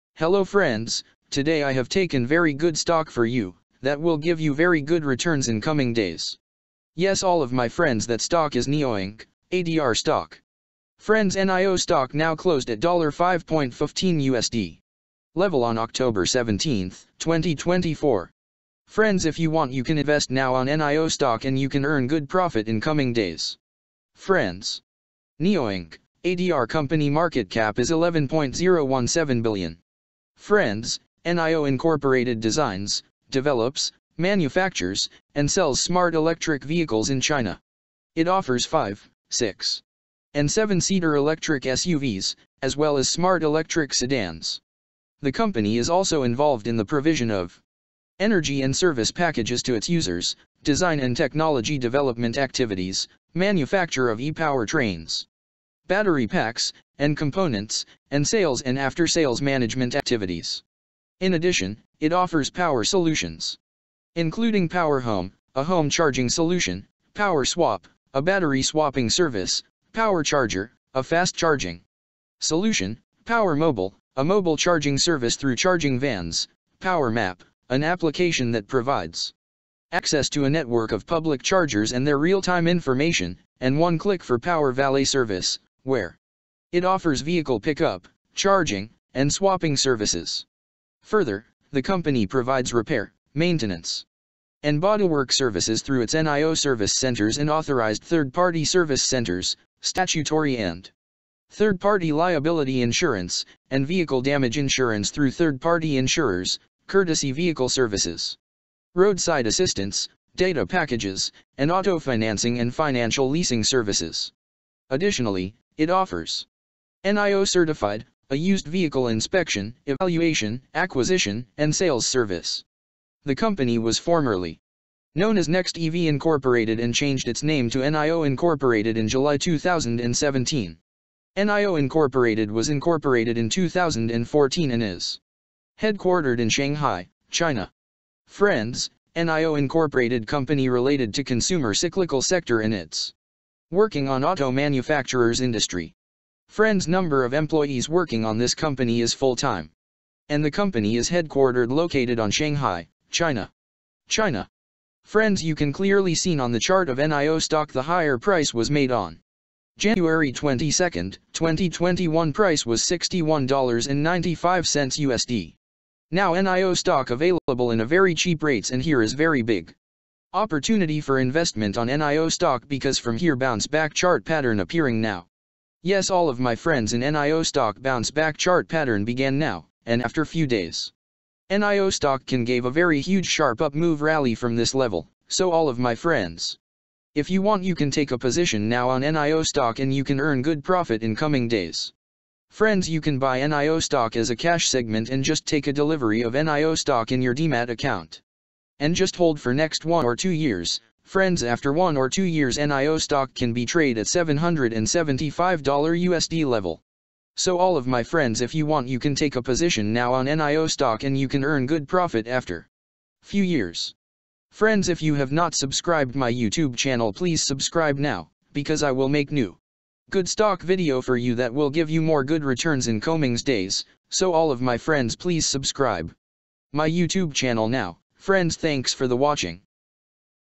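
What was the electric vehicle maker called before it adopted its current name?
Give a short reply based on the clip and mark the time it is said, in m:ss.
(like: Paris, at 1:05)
Next EV Incorporated, at 2:05.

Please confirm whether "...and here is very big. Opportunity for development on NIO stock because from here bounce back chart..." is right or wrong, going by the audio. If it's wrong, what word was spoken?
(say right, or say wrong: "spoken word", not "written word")
wrong: "investment", not "development".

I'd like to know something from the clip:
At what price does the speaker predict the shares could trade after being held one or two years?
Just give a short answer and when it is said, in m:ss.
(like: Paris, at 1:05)
$775, at 3:24.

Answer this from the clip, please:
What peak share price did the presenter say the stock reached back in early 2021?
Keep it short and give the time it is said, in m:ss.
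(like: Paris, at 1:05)
$61.95, at 2:42.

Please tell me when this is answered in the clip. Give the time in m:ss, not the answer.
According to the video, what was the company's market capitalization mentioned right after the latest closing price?
0:27.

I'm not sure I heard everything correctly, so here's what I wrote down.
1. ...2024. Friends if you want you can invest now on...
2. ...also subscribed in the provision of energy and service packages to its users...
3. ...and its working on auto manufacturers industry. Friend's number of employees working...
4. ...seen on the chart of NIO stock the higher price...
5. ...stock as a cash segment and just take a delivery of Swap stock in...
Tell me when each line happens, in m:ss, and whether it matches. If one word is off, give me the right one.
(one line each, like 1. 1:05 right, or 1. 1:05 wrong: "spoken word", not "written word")
1. 0:17 right
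2. 0:45 wrong: "involved", not "subscribed"
3. 2:22 right
4. 2:36 right
5. 3:13 wrong: "NIO", not "Swap".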